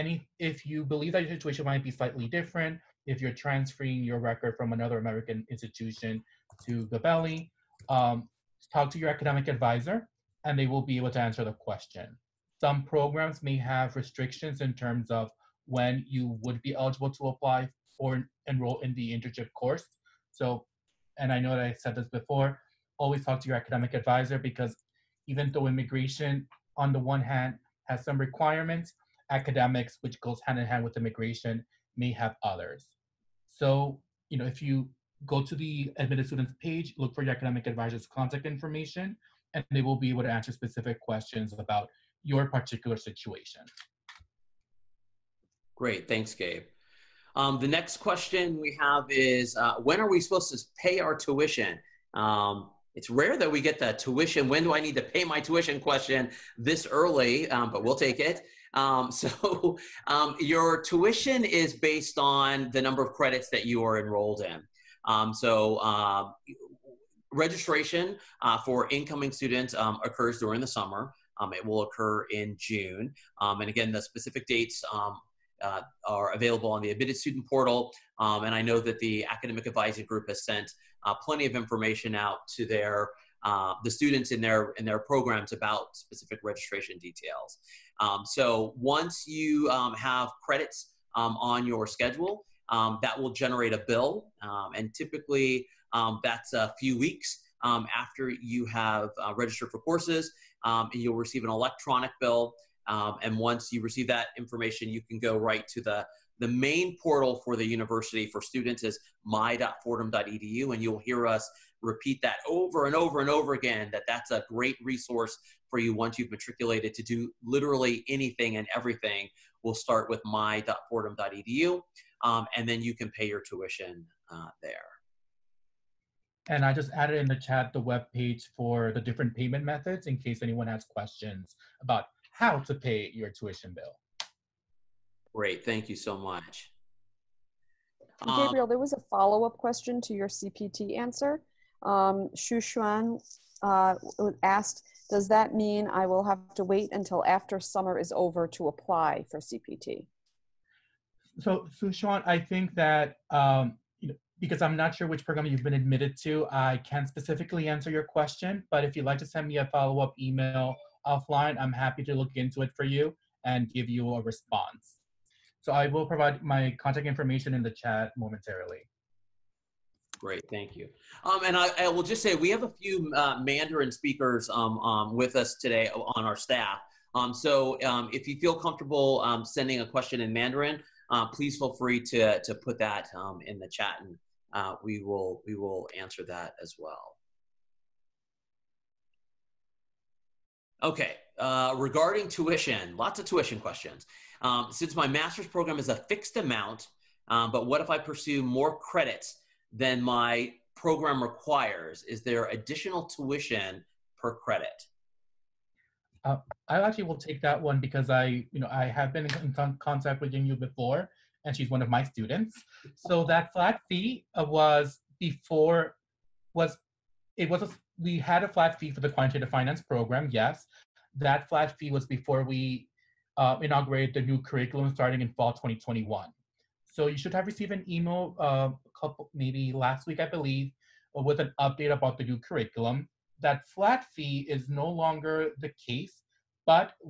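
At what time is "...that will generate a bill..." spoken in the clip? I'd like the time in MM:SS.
01:33.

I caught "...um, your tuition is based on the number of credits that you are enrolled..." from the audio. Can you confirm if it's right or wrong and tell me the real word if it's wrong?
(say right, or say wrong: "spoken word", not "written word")
right.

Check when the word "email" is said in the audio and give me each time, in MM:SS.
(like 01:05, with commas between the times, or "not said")
02:40, 03:47.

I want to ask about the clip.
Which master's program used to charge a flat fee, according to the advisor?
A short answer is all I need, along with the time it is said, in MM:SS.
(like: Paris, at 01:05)
Quantitative finance, at 03:39.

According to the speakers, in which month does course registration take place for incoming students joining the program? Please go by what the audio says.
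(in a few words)
June.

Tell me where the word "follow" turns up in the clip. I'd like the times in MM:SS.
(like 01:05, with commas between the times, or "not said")
02:19, 02:39.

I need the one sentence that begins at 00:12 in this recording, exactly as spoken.
Some programs may have restrictions in terms of when you would be eligible to apply or enroll in the internship course.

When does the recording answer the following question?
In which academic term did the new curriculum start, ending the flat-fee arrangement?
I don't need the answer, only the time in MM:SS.
03:45.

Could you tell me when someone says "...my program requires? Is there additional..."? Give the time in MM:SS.
03:19.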